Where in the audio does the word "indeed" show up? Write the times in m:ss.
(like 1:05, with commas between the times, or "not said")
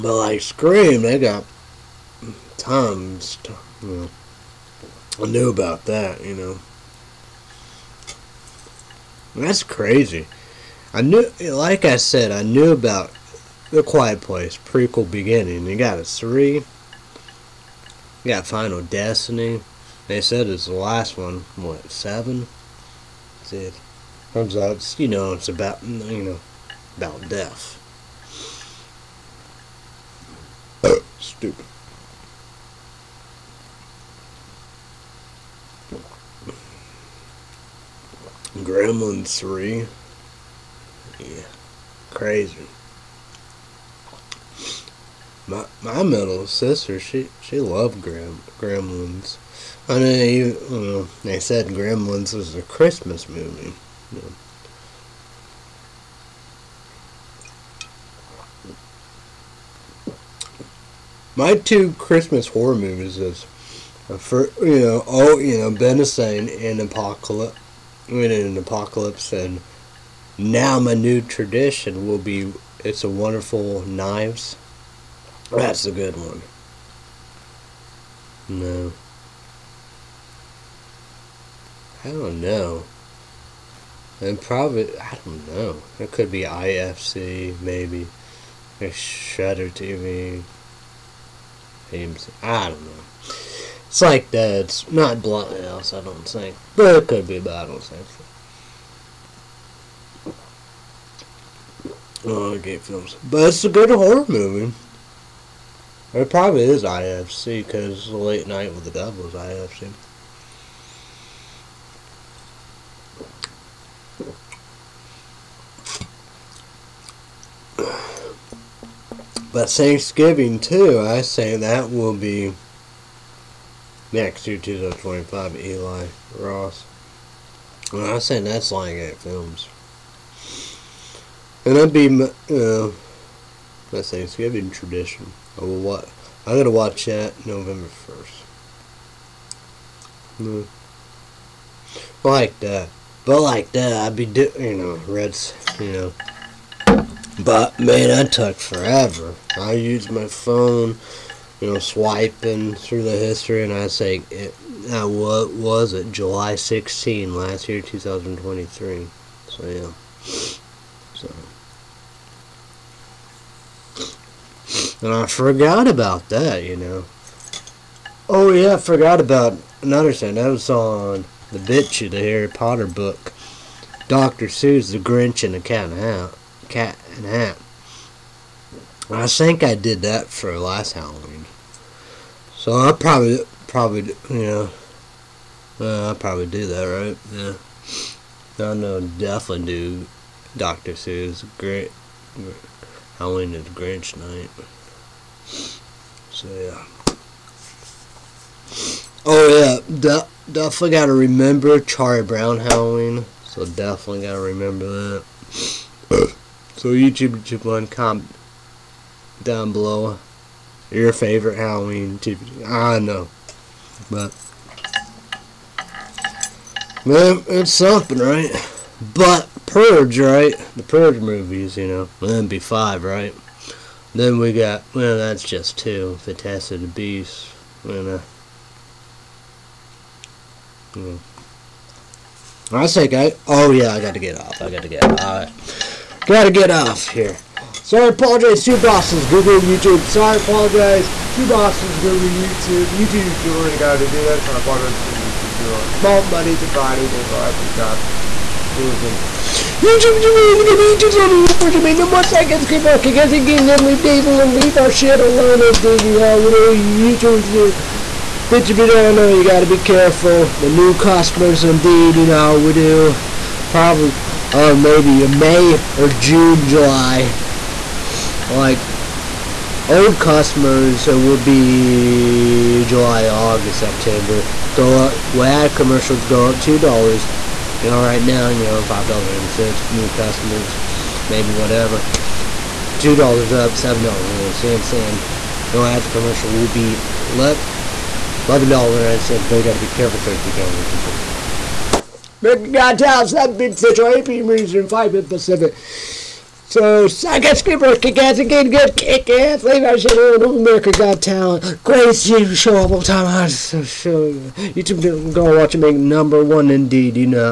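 4:21, 5:06.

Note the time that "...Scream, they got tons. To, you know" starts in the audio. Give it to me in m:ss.
0:00.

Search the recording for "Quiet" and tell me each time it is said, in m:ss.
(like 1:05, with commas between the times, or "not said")
0:13.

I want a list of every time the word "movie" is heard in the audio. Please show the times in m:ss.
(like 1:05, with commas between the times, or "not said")
0:53, 1:02, 1:44, 3:41.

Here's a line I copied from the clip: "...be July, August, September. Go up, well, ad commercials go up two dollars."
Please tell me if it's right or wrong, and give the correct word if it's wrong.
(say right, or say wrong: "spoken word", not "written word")
right.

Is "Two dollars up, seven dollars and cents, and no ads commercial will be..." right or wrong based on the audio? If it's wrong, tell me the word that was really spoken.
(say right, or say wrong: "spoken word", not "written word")
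right.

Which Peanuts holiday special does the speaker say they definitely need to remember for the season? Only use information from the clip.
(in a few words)
Charlie Brown Halloween.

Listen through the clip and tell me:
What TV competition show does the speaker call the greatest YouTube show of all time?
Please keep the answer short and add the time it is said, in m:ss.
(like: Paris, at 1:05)
America Got Talent, at 5:00.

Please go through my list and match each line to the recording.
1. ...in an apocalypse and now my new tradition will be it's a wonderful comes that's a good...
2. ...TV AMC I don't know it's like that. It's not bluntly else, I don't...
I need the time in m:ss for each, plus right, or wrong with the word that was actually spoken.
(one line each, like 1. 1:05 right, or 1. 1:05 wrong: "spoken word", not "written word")
1. 1:08 wrong: "knives", not "comes"
2. 1:29 right.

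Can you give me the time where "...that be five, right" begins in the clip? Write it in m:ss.
3:42.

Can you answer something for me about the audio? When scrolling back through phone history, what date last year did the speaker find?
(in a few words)
July 16.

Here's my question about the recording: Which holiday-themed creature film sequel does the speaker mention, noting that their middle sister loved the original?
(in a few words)
Gremlins 3.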